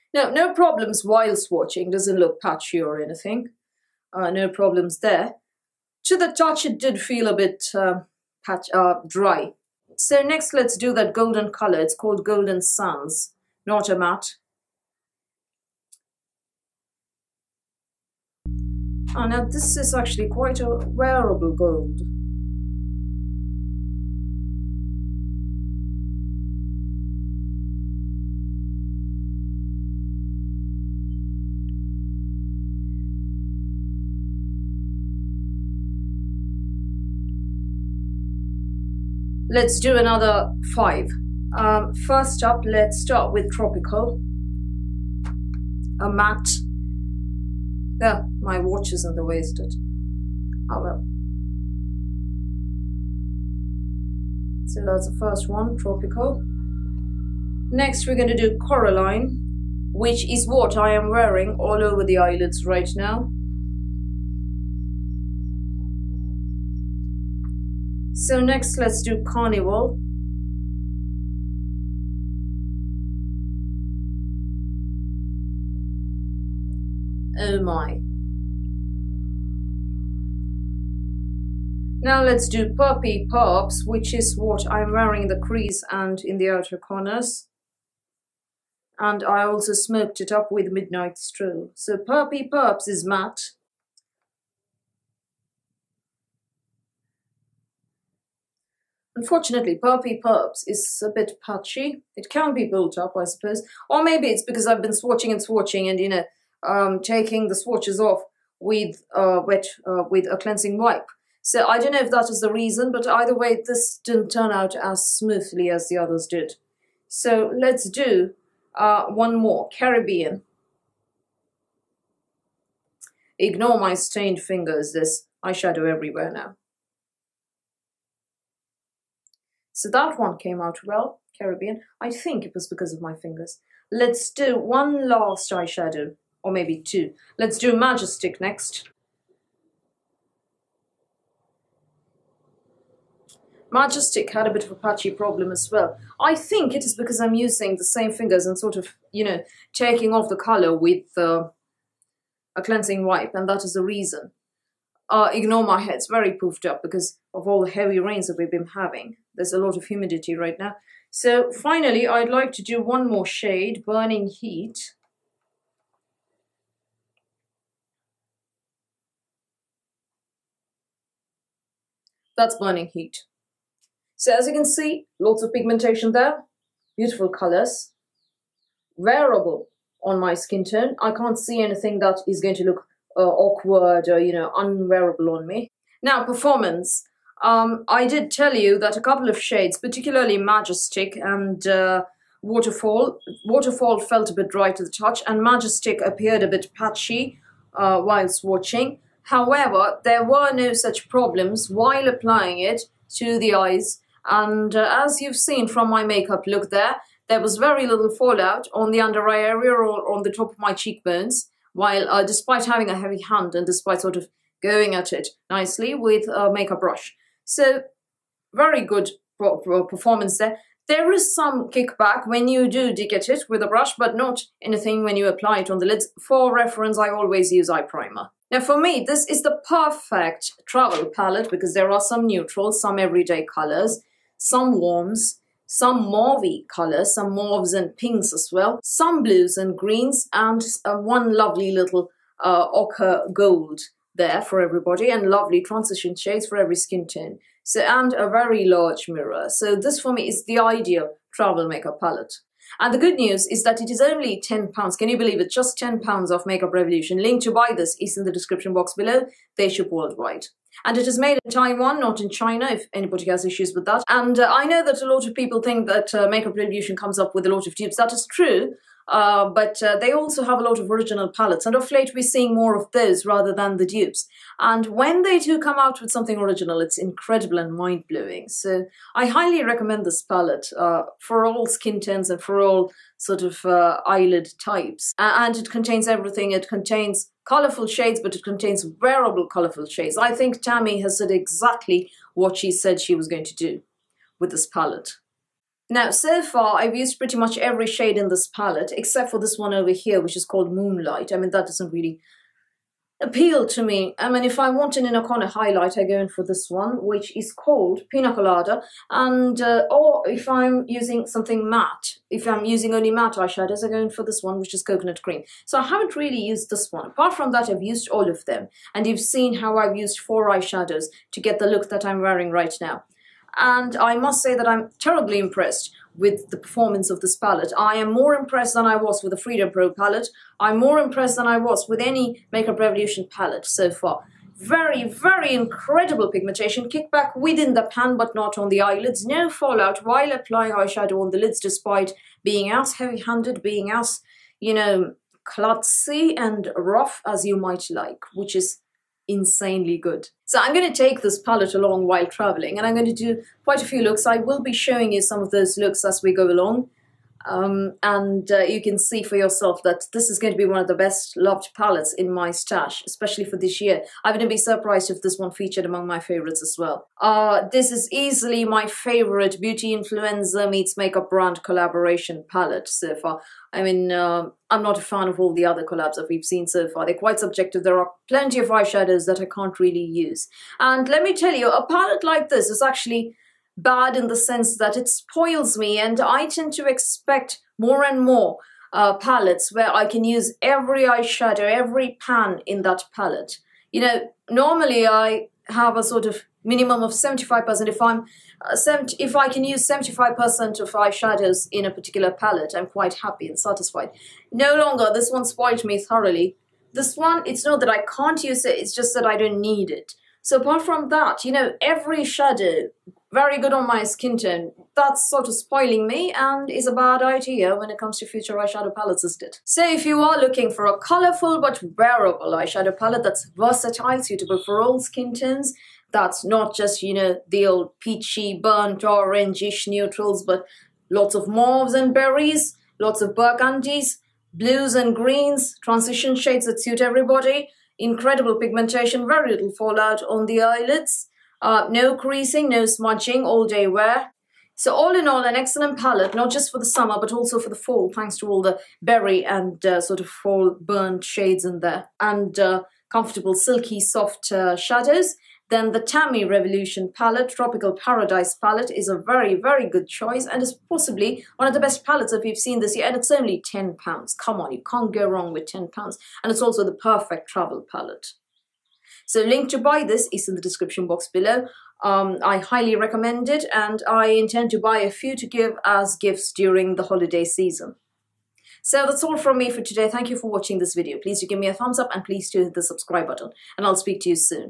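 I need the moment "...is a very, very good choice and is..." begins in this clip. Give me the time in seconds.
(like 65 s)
458 s.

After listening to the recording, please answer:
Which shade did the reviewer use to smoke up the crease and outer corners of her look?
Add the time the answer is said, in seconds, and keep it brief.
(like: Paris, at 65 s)
Midnight Stroll, at 90 s.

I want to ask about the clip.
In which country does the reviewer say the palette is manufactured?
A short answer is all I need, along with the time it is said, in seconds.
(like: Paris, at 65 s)
Taiwan, at 261 s.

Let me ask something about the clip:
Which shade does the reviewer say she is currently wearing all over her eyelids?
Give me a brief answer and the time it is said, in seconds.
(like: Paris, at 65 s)
Coraline, at 58 s.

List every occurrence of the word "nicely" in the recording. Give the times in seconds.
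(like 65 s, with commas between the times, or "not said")
215 s.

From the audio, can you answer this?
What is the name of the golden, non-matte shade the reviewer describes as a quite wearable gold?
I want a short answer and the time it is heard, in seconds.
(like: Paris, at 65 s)
Golden Suns, at 12 s.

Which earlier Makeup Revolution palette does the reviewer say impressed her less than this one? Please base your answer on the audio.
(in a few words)
Freedom Pro palette.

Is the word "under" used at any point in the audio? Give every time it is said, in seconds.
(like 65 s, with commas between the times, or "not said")
208 s.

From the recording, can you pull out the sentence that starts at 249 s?
So this for me is the ideal travel makeup palette.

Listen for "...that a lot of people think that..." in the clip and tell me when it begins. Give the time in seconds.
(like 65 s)
264 s.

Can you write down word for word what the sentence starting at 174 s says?
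So as you can see, lots of pigmentation there, beautiful colors, wearable on my skin tone.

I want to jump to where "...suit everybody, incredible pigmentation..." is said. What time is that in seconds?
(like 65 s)
436 s.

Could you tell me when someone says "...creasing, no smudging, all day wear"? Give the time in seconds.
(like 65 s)
442 s.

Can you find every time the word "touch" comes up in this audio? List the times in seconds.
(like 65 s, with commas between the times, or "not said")
6 s, 194 s.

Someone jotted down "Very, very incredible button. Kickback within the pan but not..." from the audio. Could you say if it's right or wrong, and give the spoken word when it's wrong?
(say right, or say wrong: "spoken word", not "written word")
wrong: "pigmentation", not "button".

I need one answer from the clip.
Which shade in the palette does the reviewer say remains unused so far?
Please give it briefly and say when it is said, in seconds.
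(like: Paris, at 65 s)
Moonlight, at 300 s.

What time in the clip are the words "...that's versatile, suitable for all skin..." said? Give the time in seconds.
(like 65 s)
423 s.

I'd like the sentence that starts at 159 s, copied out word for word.
There's a lot of humidity right now.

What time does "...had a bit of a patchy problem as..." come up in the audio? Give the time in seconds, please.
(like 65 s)
144 s.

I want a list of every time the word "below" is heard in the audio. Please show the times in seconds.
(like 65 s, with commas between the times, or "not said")
258 s, 471 s.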